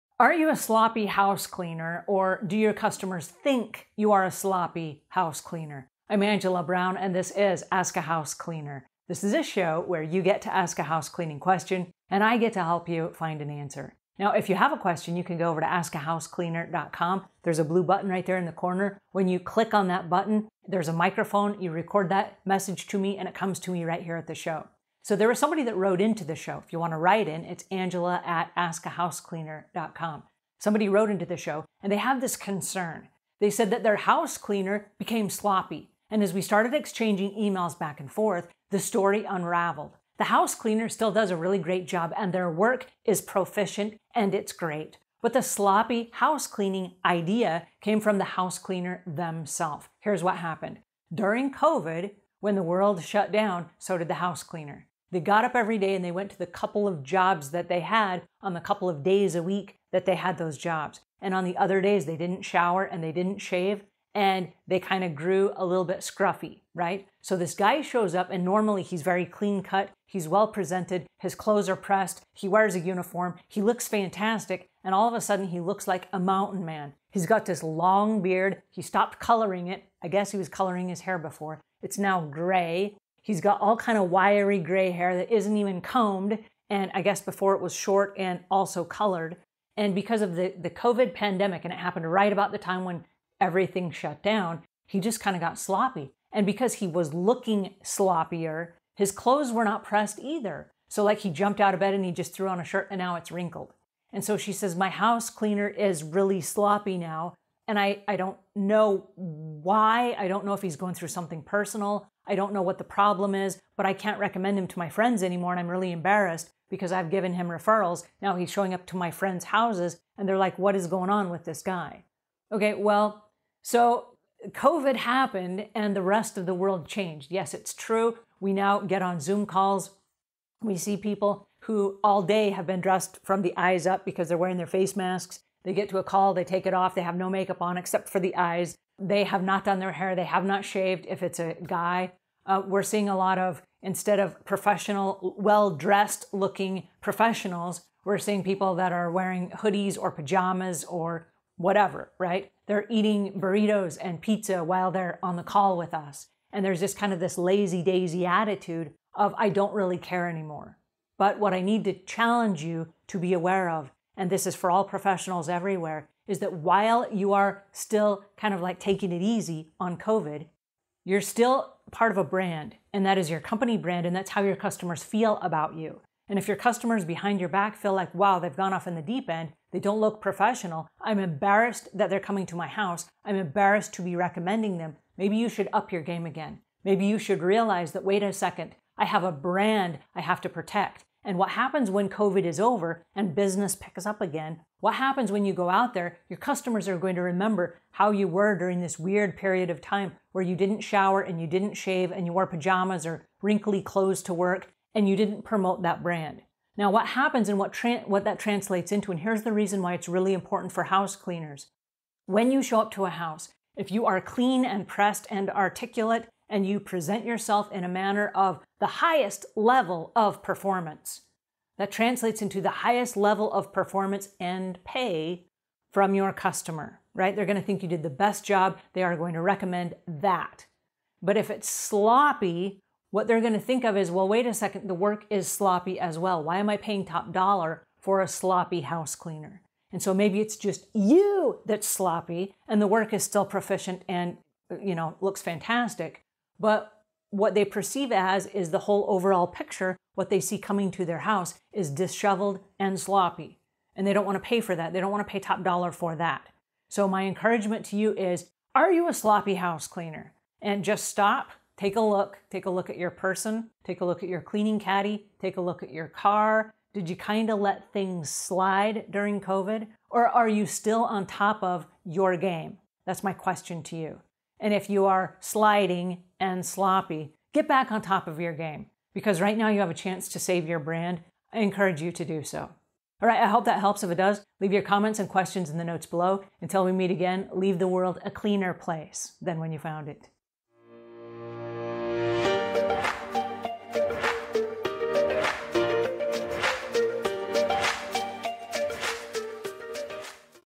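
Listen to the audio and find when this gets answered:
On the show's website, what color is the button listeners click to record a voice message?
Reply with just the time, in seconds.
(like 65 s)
17 s.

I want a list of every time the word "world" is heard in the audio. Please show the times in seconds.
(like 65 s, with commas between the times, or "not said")
52 s, 126 s, 287 s.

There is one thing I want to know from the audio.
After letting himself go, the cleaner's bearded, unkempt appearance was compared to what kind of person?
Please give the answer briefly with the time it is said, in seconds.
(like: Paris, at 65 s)
A mountain man, at 76 s.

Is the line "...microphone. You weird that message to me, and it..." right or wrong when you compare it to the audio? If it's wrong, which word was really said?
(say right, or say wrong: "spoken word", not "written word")
wrong: "record", not "weird".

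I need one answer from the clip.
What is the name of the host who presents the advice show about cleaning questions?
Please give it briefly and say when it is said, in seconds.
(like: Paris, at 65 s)
Angela Brown, at 6 s.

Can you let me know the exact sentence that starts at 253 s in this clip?
And they don't want to pay for that.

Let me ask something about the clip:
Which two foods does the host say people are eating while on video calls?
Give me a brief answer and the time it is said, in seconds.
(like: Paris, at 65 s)
Burritos and pizza, at 153 s.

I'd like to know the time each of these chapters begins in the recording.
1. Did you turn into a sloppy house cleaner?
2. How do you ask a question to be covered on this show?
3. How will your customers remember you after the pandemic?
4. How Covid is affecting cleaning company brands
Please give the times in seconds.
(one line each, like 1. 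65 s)
1. 261 s
2. 10 s
3. 194 s
4. 173 s.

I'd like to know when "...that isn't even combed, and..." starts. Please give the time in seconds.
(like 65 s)
85 s.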